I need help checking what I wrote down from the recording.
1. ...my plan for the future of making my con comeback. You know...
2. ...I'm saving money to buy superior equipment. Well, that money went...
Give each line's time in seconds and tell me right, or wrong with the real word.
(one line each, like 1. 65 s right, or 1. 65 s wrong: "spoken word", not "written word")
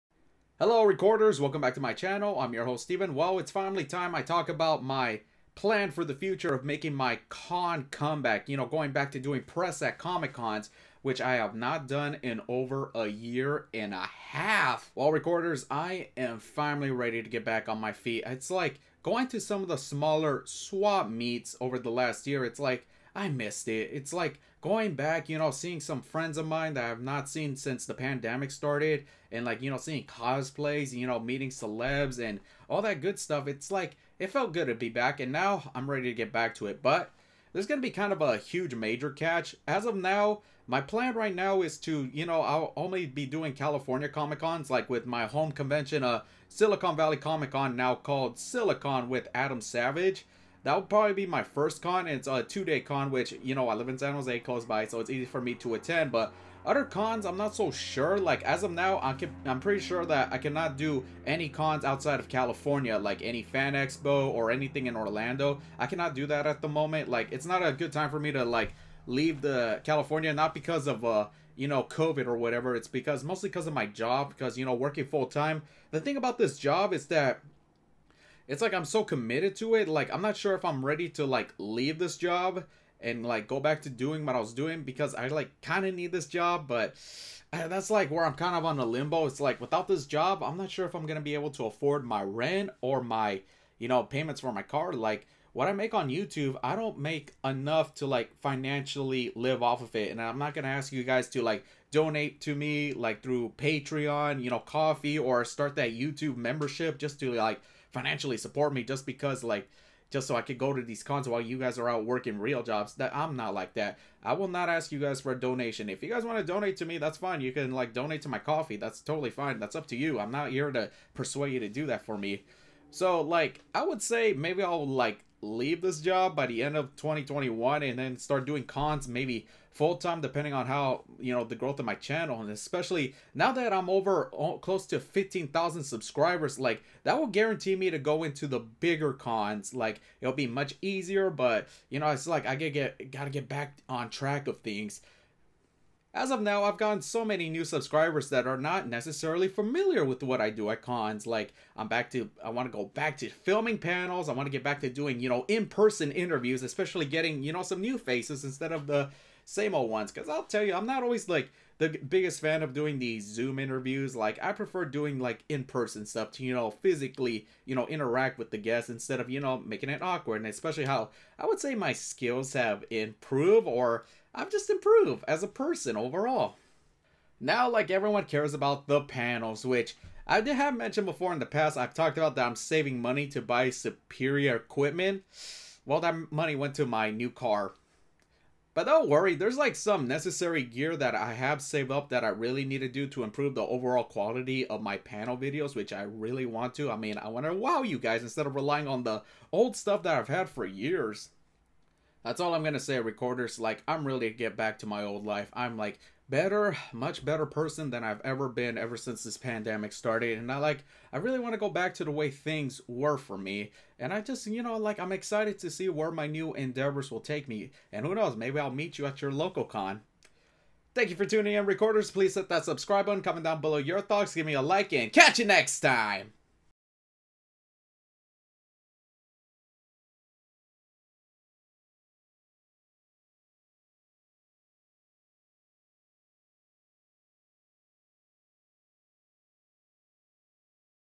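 1. 4 s right
2. 182 s right.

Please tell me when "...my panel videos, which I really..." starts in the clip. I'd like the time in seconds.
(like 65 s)
194 s.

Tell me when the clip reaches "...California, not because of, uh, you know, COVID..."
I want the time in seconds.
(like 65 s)
69 s.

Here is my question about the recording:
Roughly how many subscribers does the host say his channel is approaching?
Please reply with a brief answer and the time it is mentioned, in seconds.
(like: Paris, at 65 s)
15,000, at 134 s.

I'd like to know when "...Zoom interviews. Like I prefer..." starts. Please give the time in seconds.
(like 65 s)
163 s.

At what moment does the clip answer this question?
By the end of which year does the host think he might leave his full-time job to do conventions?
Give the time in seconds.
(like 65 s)
126 s.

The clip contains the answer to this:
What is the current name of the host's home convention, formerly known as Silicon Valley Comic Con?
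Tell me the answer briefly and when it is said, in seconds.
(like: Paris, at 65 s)
Silicon with Adam Savage, at 48 s.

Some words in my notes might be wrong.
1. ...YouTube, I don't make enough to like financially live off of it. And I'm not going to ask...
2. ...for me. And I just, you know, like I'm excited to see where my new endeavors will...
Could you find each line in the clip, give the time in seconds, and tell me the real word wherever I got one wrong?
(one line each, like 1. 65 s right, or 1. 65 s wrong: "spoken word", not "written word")
1. 96 s right
2. 213 s right.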